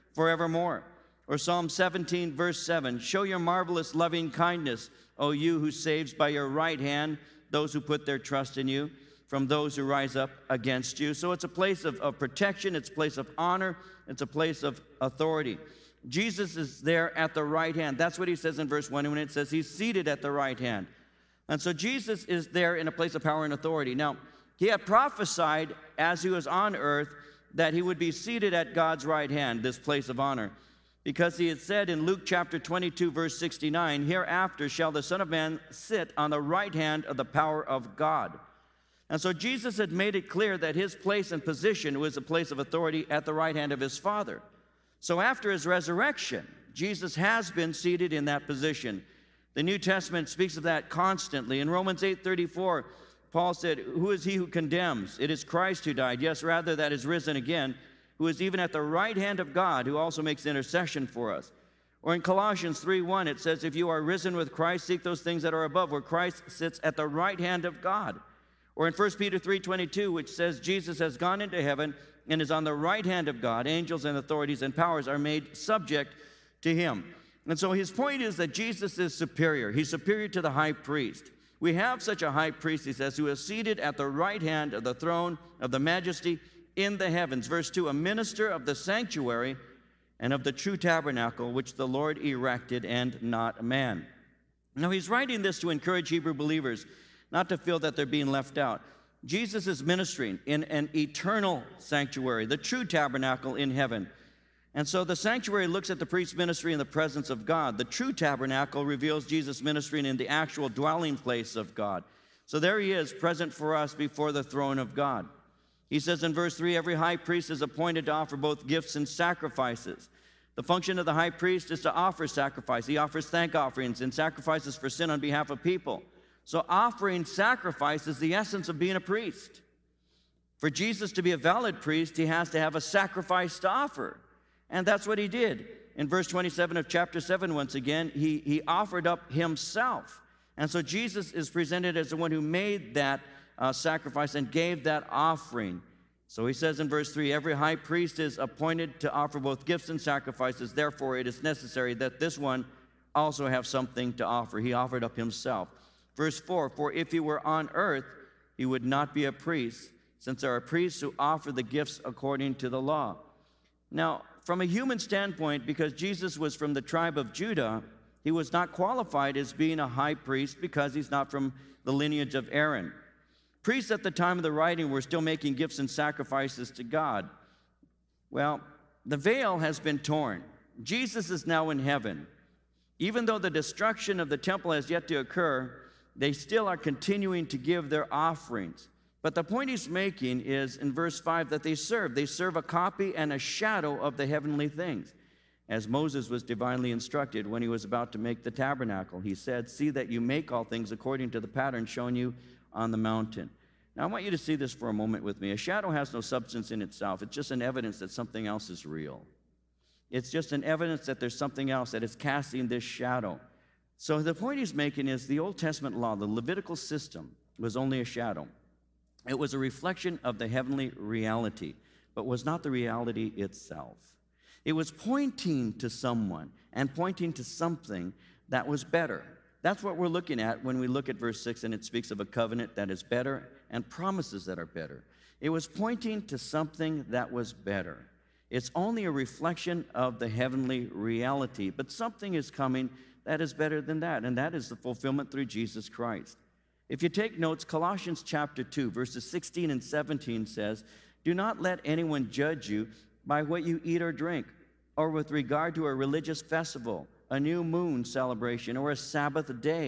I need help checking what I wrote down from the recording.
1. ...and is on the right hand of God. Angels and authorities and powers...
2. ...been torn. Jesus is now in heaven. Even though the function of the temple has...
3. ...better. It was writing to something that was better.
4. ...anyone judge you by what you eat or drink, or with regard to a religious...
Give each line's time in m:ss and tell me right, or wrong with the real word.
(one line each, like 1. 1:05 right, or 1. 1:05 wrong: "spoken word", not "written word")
1. 1:12 right
2. 2:59 wrong: "destruction", not "function"
3. 3:54 wrong: "pointing", not "writing"
4. 4:11 right.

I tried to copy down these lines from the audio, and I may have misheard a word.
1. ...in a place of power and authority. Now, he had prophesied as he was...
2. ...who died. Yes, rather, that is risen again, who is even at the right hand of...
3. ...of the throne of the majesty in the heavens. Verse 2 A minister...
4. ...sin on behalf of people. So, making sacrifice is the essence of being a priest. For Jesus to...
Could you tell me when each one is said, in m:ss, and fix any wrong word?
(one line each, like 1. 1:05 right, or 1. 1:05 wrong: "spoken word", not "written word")
1. 0:22 right
2. 0:55 right
3. 1:24 right
4. 2:04 wrong: "offering", not "making".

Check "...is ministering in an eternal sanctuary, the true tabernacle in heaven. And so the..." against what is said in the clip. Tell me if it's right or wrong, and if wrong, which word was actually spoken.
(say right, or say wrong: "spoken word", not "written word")
right.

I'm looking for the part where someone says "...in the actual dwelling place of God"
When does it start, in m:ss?
1:50.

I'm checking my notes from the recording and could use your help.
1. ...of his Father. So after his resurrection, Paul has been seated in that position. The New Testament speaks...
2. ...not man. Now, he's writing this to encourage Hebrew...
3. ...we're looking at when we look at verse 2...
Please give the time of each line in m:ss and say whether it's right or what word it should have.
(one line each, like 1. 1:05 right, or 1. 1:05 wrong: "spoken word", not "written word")
1. 0:43 wrong: "Jesus", not "Paul"
2. 1:33 right
3. 3:49 wrong: "6", not "2".